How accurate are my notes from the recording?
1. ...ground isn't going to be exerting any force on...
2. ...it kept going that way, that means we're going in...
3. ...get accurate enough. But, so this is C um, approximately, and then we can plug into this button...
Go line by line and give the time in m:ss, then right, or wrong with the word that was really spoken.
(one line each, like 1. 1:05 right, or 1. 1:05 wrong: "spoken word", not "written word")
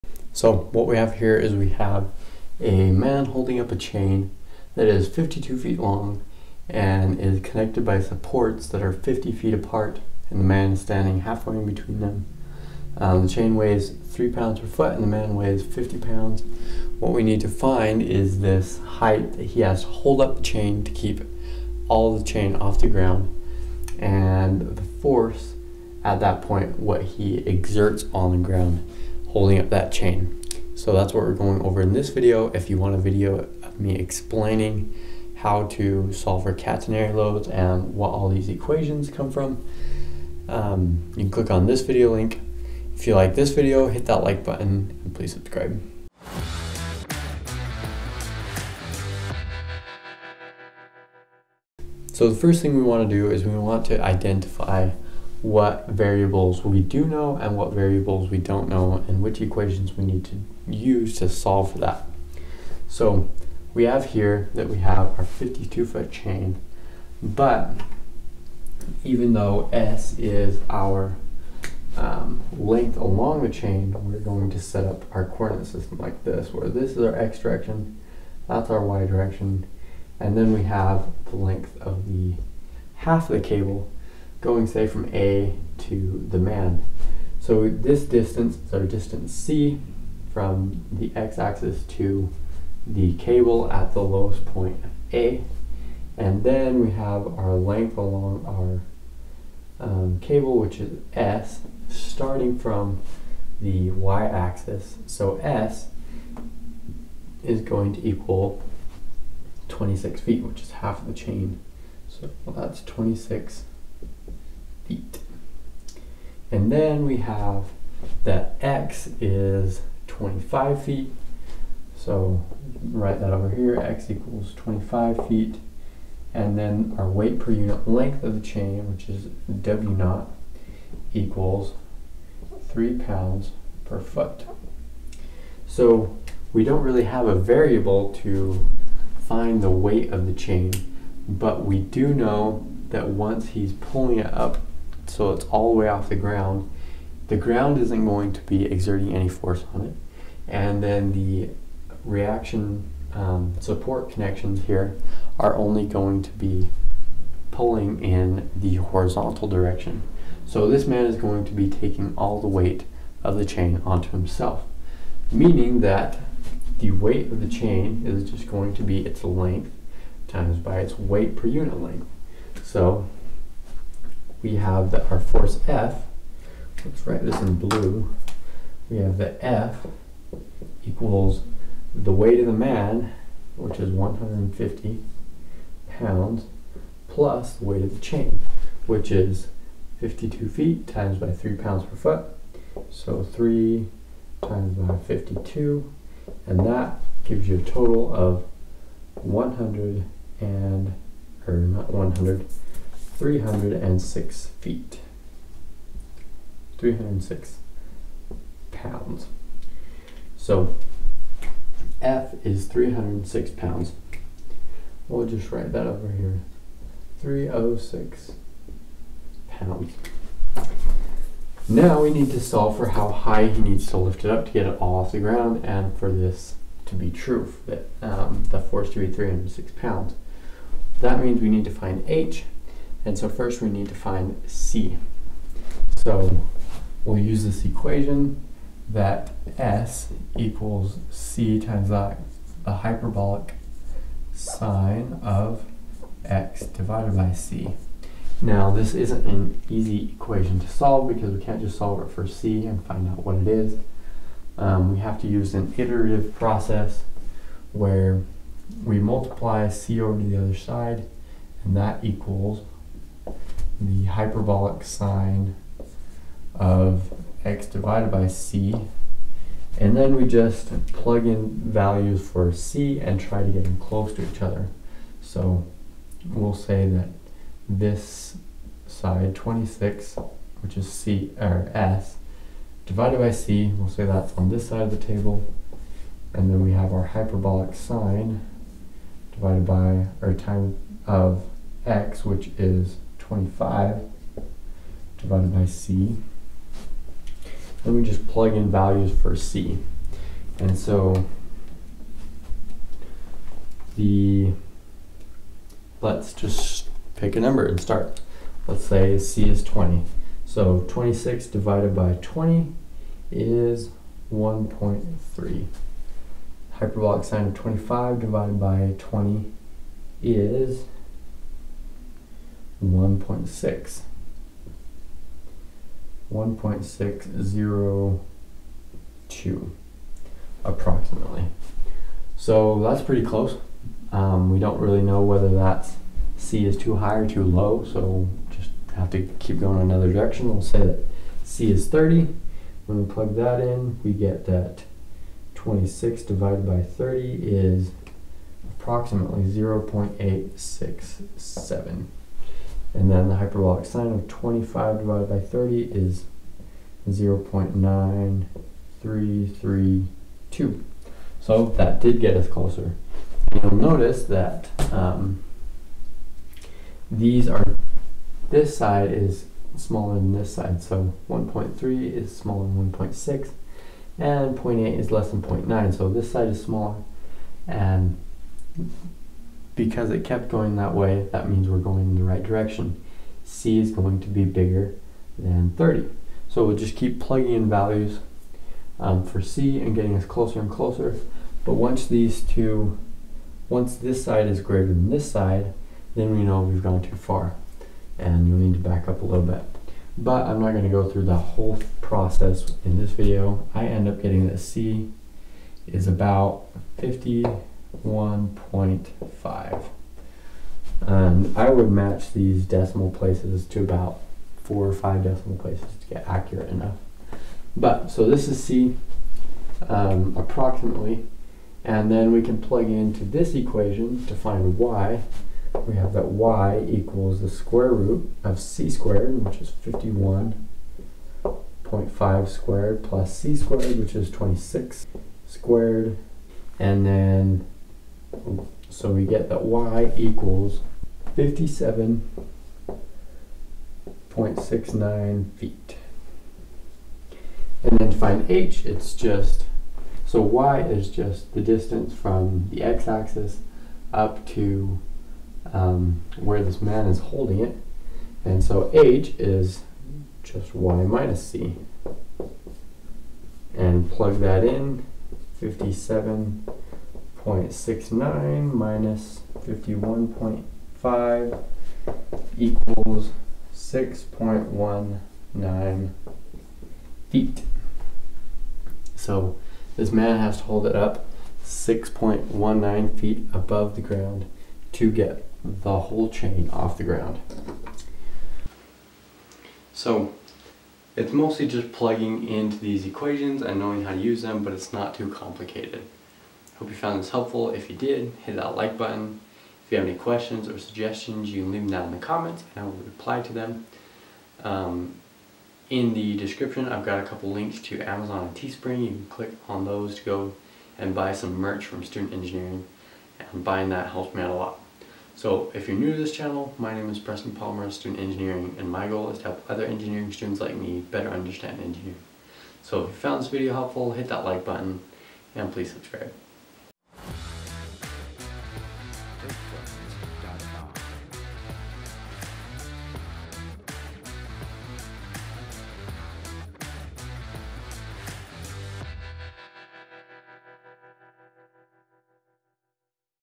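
1. 2:27 right
2. 6:20 right
3. 6:56 wrong: "equation", not "button".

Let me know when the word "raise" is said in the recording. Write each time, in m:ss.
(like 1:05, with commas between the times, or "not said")
not said.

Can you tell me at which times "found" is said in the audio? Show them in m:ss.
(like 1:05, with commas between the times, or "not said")
8:16, 8:43.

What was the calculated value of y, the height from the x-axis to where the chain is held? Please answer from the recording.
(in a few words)
57.69 feet.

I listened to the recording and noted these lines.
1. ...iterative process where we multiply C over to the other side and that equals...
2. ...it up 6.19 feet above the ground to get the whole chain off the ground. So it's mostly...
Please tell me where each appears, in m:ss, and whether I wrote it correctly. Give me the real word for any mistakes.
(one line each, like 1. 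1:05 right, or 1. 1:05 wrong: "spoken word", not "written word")
1. 4:15 right
2. 8:00 right.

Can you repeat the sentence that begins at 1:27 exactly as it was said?
So this distance is our distance C from the x-axis to the cable at the lowest point A.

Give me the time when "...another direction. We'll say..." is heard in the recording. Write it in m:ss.
5:39.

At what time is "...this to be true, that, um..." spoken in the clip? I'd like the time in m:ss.
3:46.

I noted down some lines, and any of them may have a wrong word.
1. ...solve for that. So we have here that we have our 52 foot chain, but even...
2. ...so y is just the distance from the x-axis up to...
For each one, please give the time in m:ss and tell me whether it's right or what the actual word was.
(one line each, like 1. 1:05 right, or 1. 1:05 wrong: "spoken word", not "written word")
1. 1:01 right
2. 7:30 right.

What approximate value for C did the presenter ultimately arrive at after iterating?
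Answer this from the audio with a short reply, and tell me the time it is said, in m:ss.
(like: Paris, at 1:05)
51.5, at 6:46.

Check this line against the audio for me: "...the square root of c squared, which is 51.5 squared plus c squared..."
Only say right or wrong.
right.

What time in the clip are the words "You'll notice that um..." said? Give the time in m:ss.
6:03.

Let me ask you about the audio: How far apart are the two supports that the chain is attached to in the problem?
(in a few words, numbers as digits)
50 feet.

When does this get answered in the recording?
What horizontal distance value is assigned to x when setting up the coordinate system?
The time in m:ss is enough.
1:58.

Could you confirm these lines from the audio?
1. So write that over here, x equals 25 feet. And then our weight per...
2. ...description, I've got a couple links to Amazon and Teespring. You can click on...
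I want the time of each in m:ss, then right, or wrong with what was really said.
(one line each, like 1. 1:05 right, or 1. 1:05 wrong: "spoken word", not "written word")
1. 2:01 right
2. 8:26 right.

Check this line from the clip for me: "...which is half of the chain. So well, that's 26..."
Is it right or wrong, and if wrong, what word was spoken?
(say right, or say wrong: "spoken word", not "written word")
right.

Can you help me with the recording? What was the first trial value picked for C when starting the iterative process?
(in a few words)
20.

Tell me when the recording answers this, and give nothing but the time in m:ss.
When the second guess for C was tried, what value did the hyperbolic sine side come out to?
5:57.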